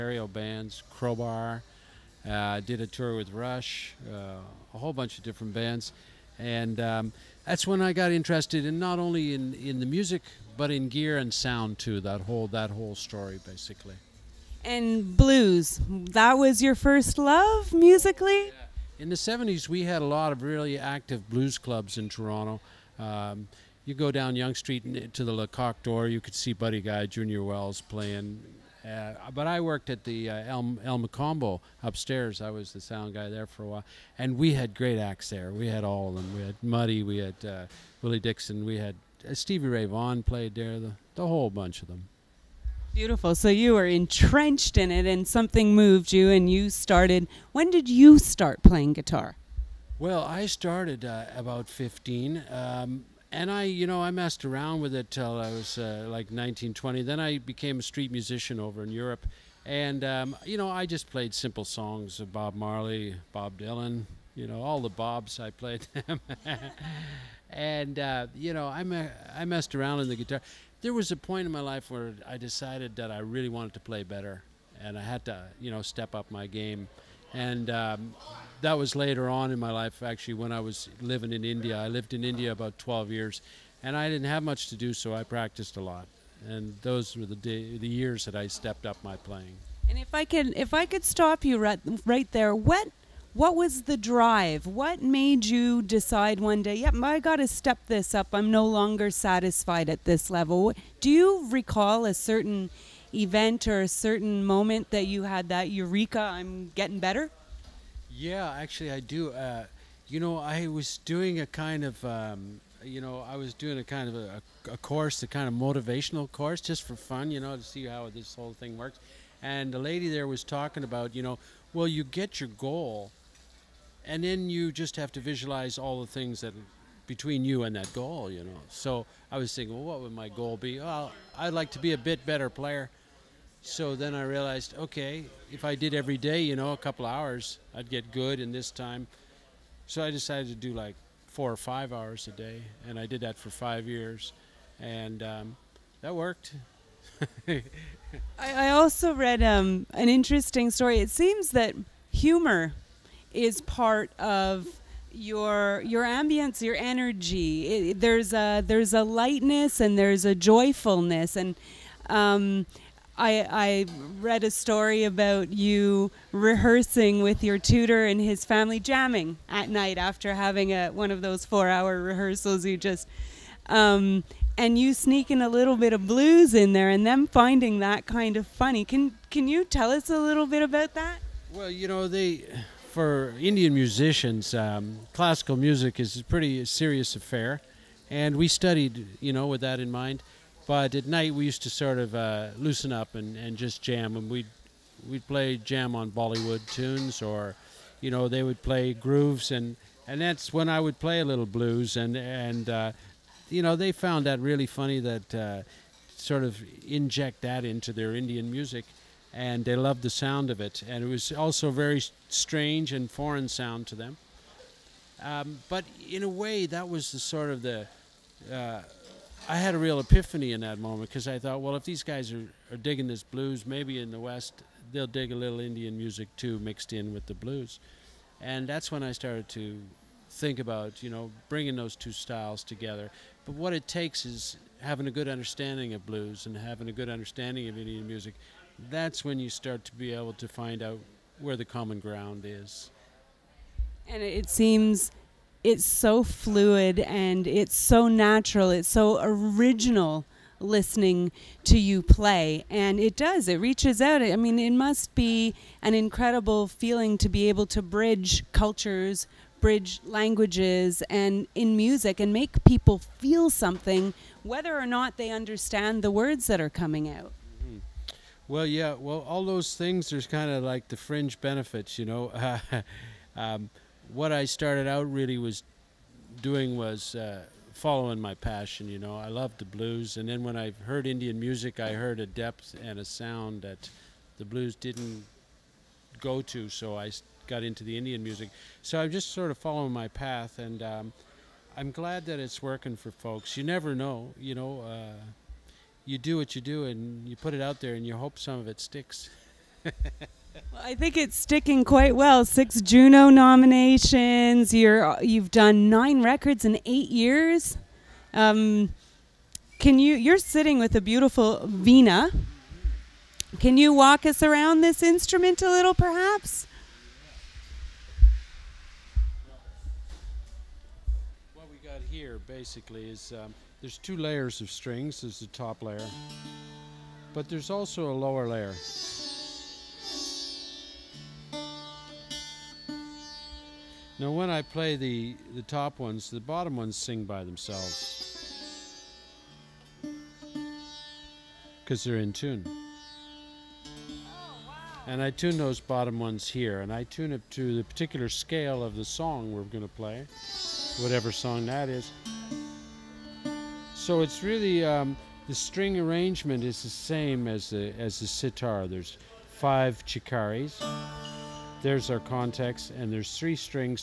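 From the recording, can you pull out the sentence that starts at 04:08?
It's so original listening to you play.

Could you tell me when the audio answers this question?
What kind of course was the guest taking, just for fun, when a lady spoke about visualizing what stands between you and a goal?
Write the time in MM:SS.
01:55.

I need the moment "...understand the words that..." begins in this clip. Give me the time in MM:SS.
04:25.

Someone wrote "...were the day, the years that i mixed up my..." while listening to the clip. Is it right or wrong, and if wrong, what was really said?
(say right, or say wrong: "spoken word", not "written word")
wrong: "stepped", not "mixed".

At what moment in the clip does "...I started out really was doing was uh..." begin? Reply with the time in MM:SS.
04:34.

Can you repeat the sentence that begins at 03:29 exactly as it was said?
And they loved the sound of it.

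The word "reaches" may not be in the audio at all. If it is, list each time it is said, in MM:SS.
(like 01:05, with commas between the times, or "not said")
04:13.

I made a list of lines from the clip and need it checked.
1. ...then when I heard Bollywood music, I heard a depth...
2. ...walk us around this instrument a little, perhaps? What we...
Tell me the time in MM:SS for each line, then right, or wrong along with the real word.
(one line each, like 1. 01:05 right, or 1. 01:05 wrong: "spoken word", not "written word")
1. 04:40 wrong: "Indian", not "Bollywood"
2. 05:13 right.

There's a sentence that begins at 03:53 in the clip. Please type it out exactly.
But what it takes is having a good understanding of blues and having a good understanding of Indian music.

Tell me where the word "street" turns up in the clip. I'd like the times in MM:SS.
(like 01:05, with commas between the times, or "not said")
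00:24, 00:57.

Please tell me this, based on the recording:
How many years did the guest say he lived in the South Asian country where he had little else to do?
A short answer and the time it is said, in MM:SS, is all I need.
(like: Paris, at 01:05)
12 years, at 01:22.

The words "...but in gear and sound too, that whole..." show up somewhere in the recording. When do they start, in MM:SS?
00:10.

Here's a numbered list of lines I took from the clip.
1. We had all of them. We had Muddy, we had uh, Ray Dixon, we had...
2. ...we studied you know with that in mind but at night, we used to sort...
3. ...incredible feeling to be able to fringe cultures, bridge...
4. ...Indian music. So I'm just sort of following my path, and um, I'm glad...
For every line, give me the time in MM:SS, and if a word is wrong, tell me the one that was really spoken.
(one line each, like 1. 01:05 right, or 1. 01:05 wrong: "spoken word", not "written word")
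1. 00:35 wrong: "Willie", not "Ray"
2. 03:08 right
3. 04:15 wrong: "bridge", not "fringe"
4. 04:47 right.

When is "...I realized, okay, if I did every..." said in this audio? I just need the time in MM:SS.
02:14.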